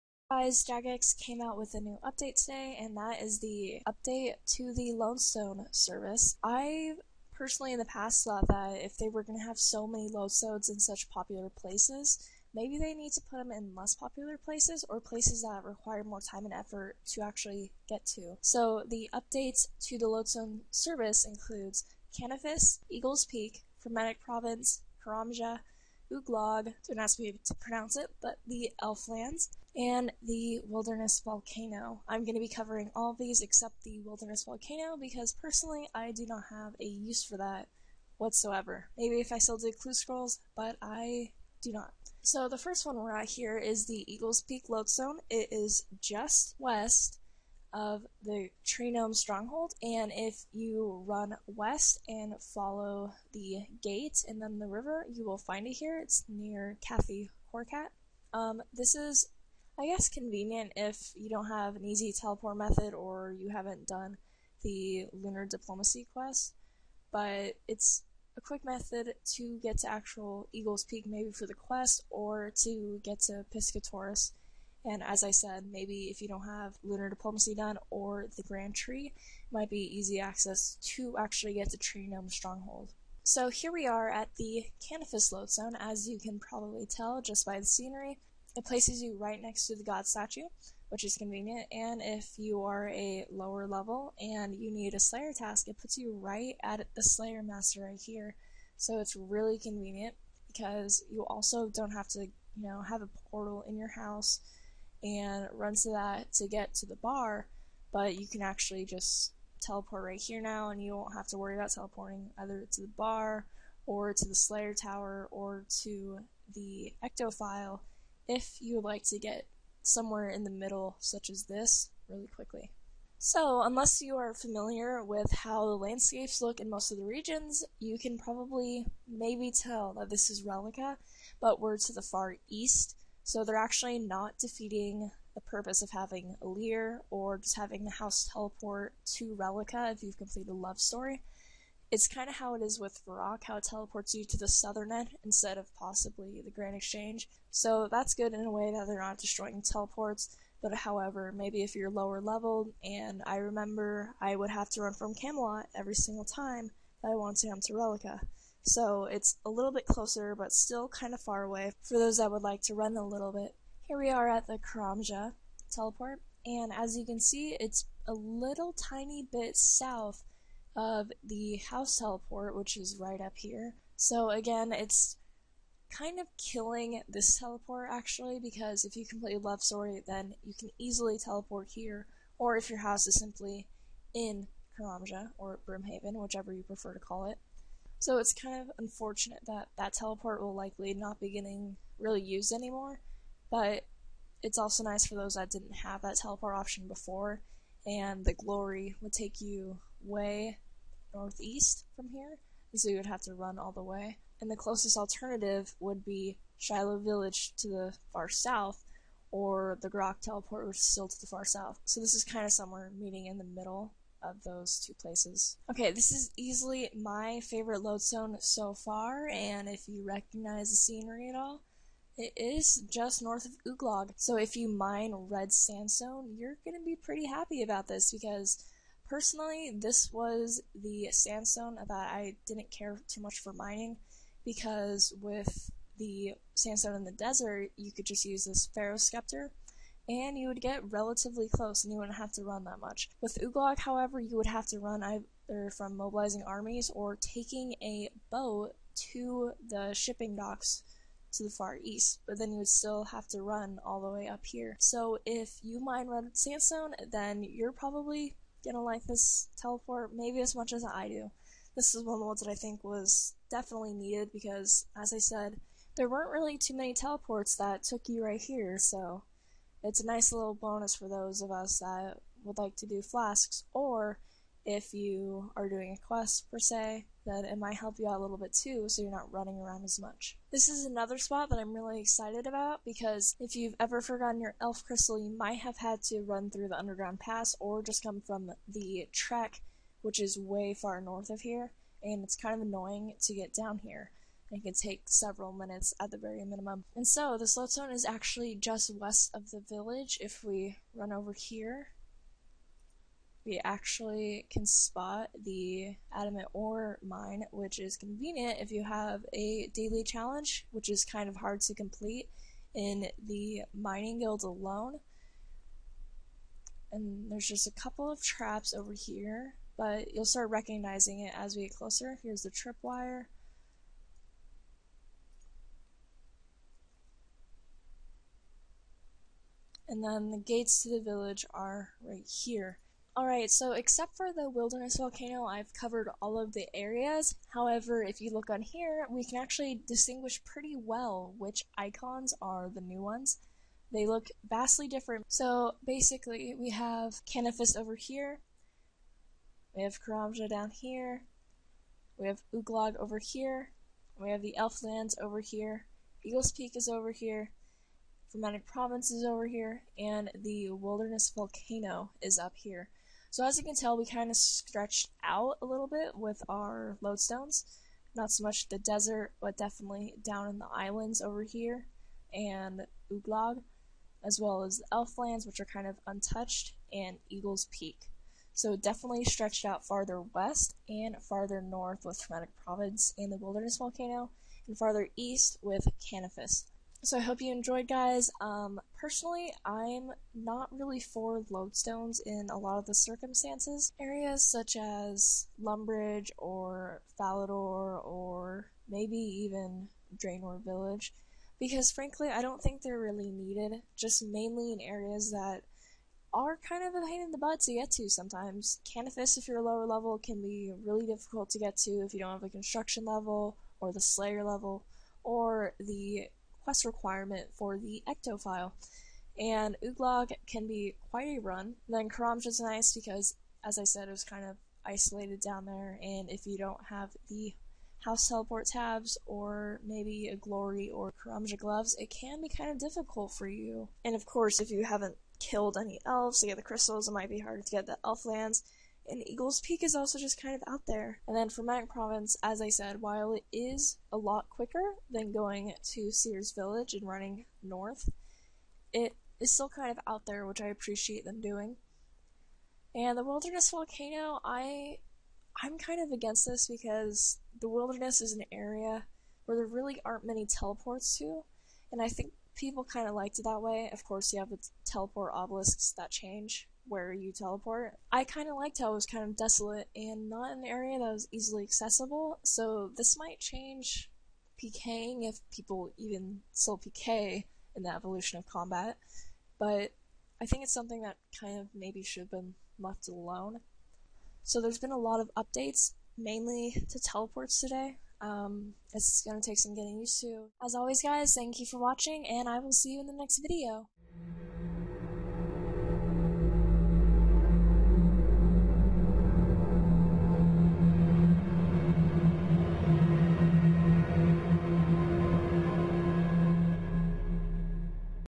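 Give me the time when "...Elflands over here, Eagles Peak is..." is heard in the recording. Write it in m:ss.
5:54.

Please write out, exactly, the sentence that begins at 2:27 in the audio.
So that's good in a way that they're not destroying teleports.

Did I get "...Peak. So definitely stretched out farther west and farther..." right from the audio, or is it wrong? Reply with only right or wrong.
right.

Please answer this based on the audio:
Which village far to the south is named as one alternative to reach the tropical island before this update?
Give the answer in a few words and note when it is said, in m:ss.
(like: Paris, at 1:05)
Shilo Village, at 3:26.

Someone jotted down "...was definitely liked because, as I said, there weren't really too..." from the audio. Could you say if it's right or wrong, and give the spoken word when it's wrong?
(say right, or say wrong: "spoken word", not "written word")
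wrong: "needed", not "liked".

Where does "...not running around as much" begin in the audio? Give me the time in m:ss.
4:39.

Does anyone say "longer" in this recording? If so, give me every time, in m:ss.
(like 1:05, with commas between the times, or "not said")
not said.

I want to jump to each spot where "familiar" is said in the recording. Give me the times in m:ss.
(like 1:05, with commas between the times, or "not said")
2:04.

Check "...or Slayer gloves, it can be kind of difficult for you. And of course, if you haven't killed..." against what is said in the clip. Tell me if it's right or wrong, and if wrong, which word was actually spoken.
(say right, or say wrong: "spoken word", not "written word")
wrong: "Karamja", not "Slayer".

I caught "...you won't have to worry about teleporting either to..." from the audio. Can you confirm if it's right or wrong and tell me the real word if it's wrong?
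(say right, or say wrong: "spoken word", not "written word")
right.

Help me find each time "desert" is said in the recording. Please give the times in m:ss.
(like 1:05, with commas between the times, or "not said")
3:57, 6:08.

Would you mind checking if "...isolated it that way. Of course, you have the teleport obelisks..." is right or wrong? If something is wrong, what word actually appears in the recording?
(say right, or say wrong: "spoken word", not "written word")
wrong: "liked", not "isolated".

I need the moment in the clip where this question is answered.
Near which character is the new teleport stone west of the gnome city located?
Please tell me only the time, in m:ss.
0:56.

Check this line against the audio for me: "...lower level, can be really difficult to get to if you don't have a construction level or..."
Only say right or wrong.
right.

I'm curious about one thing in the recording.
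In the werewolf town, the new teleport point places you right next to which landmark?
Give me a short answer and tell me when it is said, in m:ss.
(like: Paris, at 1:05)
The god statue, at 1:29.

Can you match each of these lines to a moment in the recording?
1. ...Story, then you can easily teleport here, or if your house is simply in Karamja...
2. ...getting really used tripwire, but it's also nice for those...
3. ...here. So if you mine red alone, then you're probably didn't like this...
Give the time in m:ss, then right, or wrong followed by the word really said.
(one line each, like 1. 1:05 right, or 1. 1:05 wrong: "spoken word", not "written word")
1. 2:59 right
2. 3:11 wrong: "anymore", not "tripwire"
3. 4:14 wrong: "sandstone", not "alone".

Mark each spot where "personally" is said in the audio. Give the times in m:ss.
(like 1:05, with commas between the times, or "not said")
0:07, 0:35, 3:49, 6:28.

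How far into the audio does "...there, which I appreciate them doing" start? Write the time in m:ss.
7:30.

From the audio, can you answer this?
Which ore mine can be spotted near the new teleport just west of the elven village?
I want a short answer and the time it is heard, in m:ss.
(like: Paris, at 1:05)
Adamant, at 5:06.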